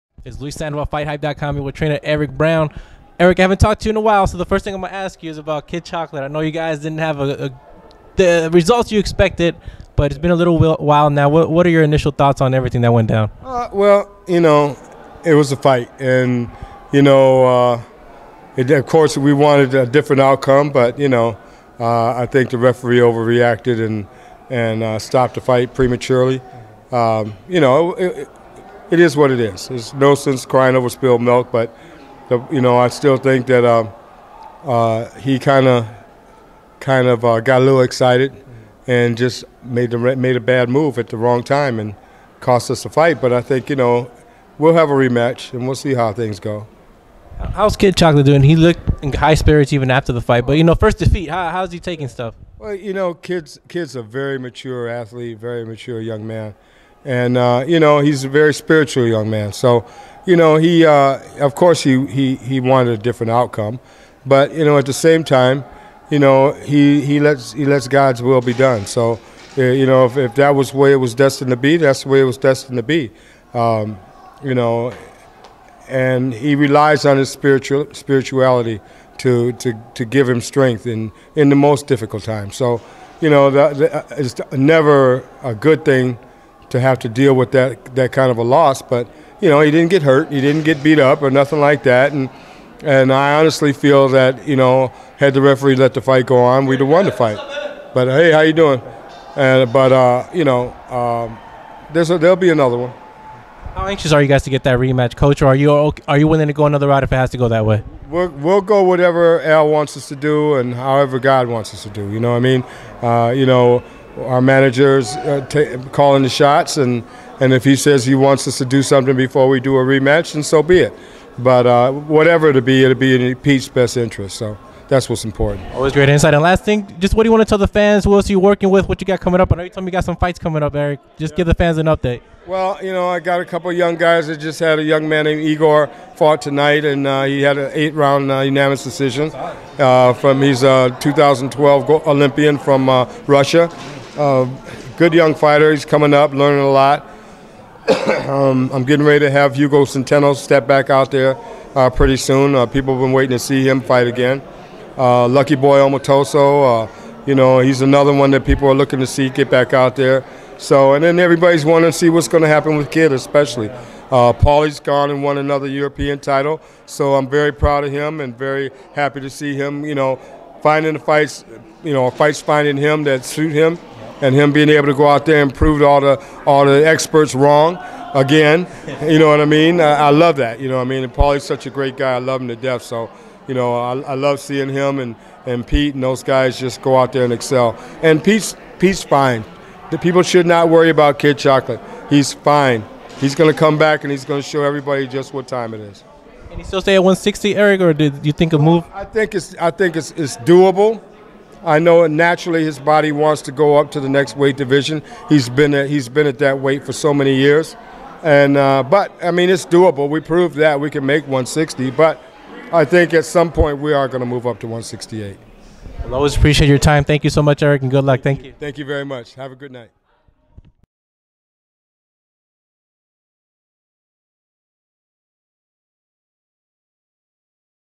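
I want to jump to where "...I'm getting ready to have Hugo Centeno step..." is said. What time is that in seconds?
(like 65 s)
148 s.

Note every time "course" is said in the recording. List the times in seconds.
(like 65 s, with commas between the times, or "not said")
18 s, 61 s.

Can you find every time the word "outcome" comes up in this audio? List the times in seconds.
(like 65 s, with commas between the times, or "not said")
20 s, 63 s.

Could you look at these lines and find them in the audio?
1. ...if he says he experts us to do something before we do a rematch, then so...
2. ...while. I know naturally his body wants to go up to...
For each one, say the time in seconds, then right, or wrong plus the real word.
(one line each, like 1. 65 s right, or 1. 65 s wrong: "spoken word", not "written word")
1. 117 s wrong: "wants", not "experts"
2. 200 s wrong: "doable", not "while".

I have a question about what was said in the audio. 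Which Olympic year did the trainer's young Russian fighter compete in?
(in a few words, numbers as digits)
2012.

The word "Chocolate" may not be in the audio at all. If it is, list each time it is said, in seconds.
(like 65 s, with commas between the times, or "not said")
5 s, 47 s, 191 s.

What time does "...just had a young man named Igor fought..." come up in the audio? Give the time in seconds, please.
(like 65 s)
134 s.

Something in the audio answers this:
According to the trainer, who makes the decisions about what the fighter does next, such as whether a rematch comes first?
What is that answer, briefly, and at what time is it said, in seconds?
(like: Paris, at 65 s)
Al, at 109 s.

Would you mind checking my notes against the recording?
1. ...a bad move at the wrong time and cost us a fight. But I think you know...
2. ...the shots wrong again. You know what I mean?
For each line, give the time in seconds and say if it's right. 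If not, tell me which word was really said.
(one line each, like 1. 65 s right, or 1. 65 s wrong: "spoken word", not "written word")
1. 40 s right
2. 176 s wrong: "experts", not "shots".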